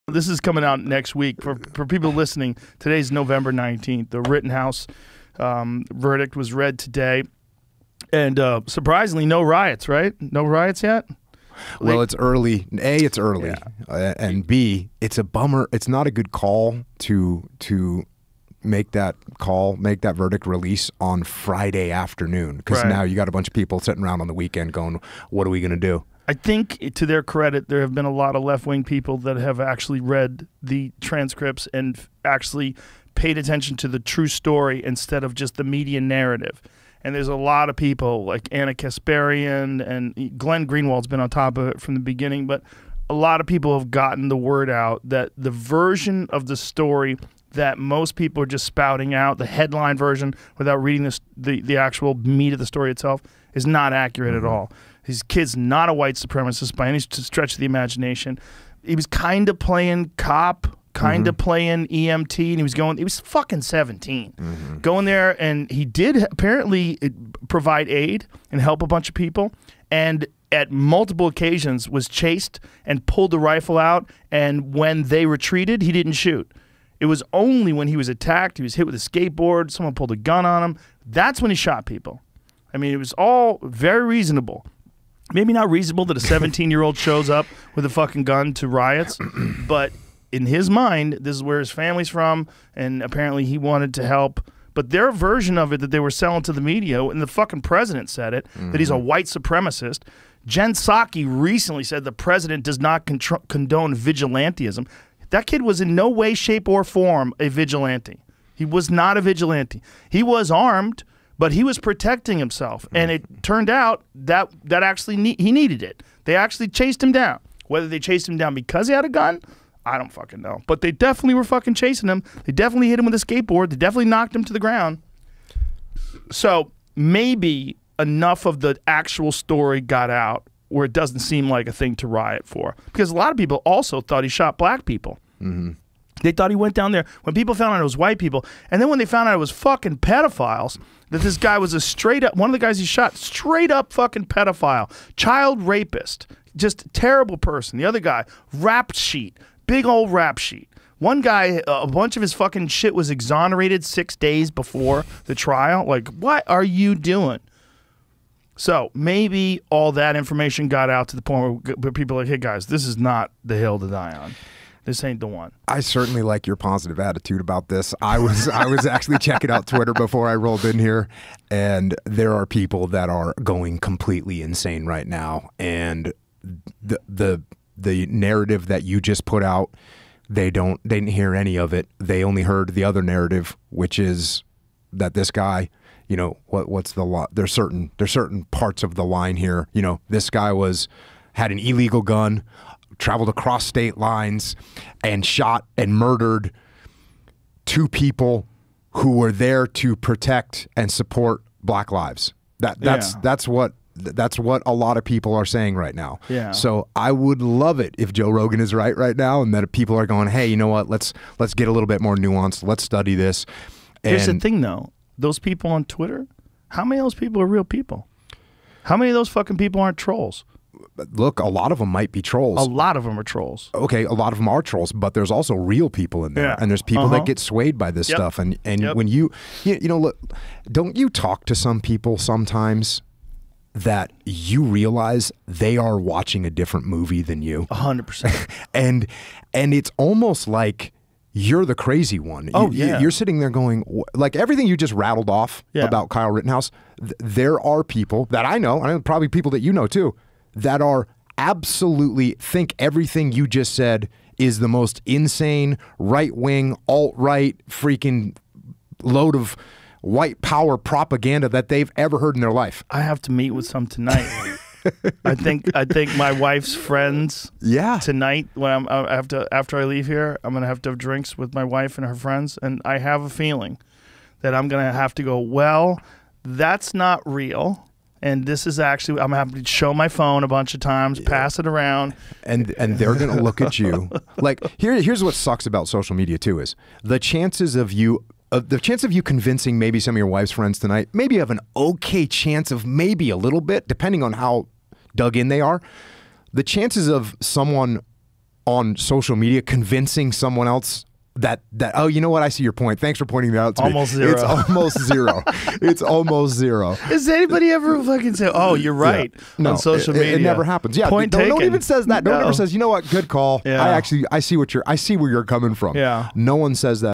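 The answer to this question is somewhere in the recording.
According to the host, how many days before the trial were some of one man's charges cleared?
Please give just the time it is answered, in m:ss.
2:33.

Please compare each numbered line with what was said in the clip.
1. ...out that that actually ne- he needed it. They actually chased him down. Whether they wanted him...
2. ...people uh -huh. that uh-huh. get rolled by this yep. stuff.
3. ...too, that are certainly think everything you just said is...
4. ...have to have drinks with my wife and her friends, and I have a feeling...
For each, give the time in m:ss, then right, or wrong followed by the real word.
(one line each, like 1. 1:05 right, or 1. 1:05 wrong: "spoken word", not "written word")
1. 1:53 wrong: "chased", not "wanted"
2. 3:46 wrong: "swayed", not "rolled"
3. 4:09 wrong: "absolutely", not "certainly"
4. 4:30 right.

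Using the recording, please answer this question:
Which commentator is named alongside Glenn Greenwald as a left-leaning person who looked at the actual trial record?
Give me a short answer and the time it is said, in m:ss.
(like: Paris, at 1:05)
Ana Kasparian, at 0:38.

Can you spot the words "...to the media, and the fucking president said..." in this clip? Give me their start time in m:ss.
1:36.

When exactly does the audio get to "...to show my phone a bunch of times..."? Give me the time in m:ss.
4:39.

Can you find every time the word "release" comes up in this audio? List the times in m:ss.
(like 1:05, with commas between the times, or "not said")
0:20.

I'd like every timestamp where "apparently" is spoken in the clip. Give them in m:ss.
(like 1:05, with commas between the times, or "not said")
1:06, 1:33.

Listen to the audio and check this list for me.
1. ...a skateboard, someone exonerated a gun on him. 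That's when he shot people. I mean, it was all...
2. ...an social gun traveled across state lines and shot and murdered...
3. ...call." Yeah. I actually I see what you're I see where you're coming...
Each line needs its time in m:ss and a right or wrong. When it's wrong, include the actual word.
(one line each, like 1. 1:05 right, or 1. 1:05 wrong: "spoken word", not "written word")
1. 1:18 wrong: "pulled", not "exonerated"
2. 3:11 wrong: "illegal", not "social"
3. 5:13 right.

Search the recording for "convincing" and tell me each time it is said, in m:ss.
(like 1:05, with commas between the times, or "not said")
4:49, 4:59.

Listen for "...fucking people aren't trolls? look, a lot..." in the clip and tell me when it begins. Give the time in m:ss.
3:39.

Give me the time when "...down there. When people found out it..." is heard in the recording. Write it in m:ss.
2:16.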